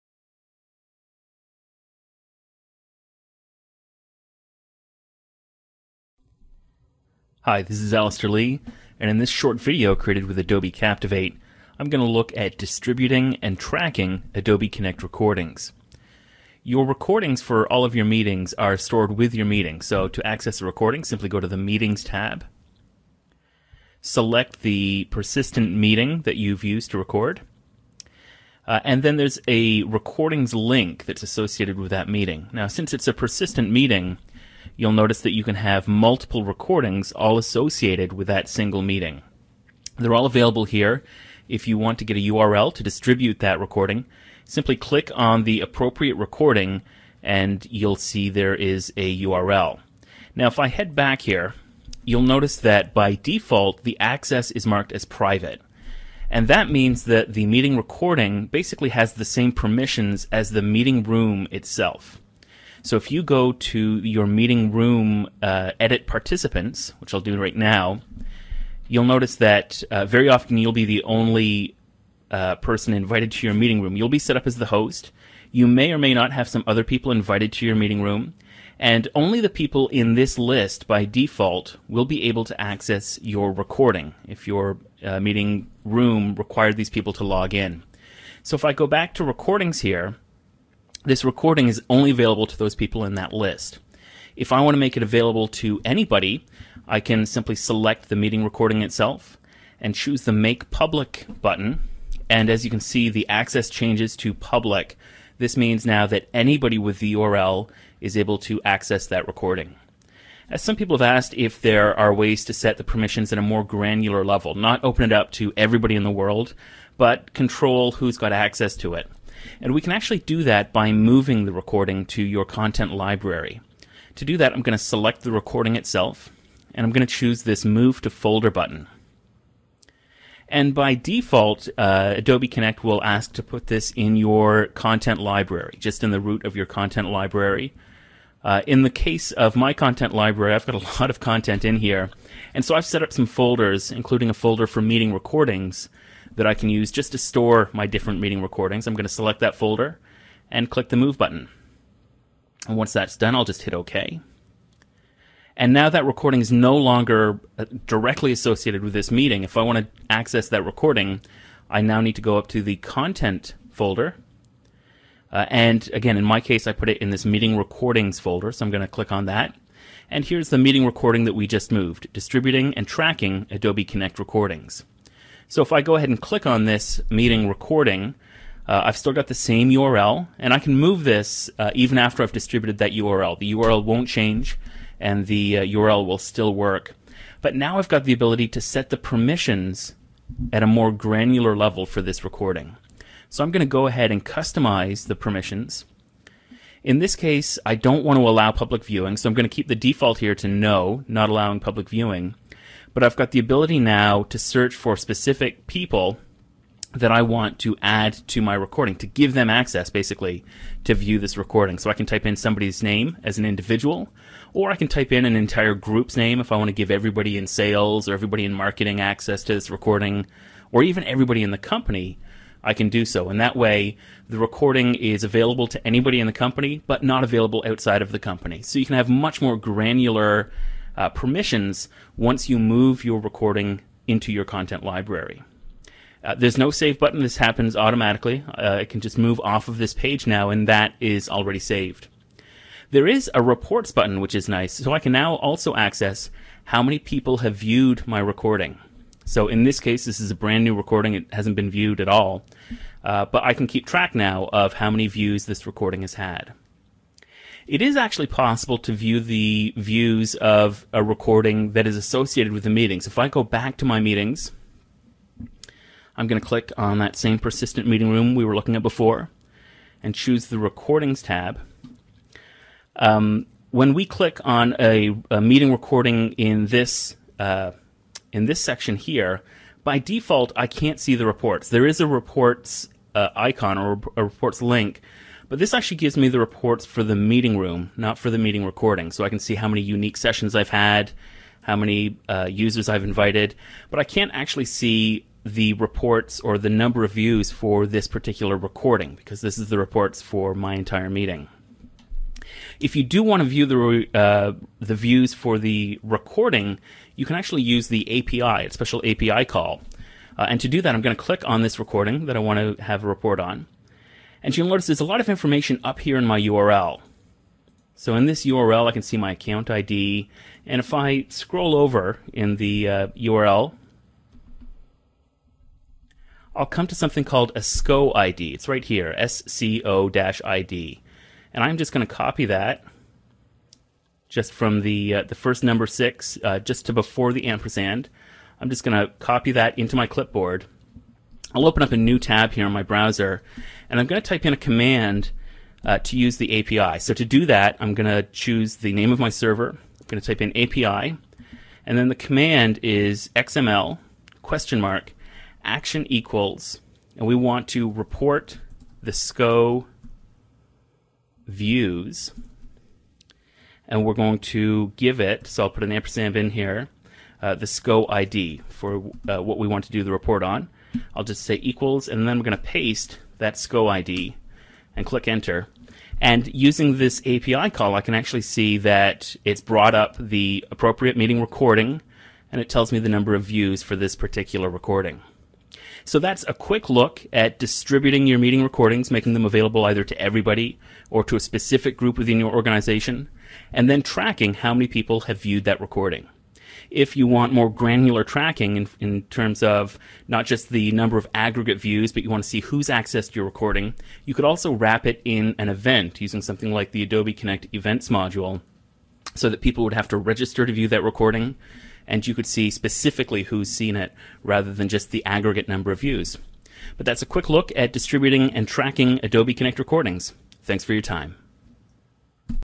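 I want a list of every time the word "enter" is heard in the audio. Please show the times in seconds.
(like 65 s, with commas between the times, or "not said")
375 s.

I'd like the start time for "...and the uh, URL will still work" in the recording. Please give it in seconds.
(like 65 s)
184 s.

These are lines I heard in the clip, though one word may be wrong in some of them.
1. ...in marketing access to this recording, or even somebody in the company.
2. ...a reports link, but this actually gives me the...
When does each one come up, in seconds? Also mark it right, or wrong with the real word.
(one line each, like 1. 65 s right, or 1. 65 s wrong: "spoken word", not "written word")
1. 218 s wrong: "everybody", not "somebody"
2. 284 s right.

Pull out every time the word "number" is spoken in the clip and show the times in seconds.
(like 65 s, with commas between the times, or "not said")
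296 s, 335 s, 383 s, 400 s, 415 s.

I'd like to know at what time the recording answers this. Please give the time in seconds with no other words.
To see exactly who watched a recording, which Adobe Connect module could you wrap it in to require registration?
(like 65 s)
407 s.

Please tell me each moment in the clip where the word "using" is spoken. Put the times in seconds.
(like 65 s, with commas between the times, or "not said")
376 s, 406 s.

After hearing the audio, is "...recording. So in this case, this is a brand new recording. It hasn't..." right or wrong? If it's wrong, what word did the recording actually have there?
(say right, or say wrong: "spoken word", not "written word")
right.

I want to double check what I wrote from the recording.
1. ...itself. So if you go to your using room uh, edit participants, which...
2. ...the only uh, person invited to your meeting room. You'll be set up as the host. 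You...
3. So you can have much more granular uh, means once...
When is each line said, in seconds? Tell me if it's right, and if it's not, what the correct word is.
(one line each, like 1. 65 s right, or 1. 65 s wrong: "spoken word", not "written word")
1. 61 s wrong: "meeting", not "using"
2. 70 s right
3. 228 s wrong: "permissions", not "means".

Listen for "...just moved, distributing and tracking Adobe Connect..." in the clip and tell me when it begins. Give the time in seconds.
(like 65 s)
171 s.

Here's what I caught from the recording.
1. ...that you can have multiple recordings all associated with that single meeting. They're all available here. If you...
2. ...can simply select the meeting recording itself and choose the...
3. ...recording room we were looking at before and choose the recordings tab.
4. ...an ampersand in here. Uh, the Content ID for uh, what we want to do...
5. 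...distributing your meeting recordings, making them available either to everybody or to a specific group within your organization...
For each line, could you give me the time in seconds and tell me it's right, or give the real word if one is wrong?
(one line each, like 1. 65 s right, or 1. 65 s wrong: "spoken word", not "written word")
1. 35 s right
2. 96 s right
3. 267 s wrong: "meeting", not "recording"
4. 365 s wrong: "SCO", not "Content"
5. 387 s right.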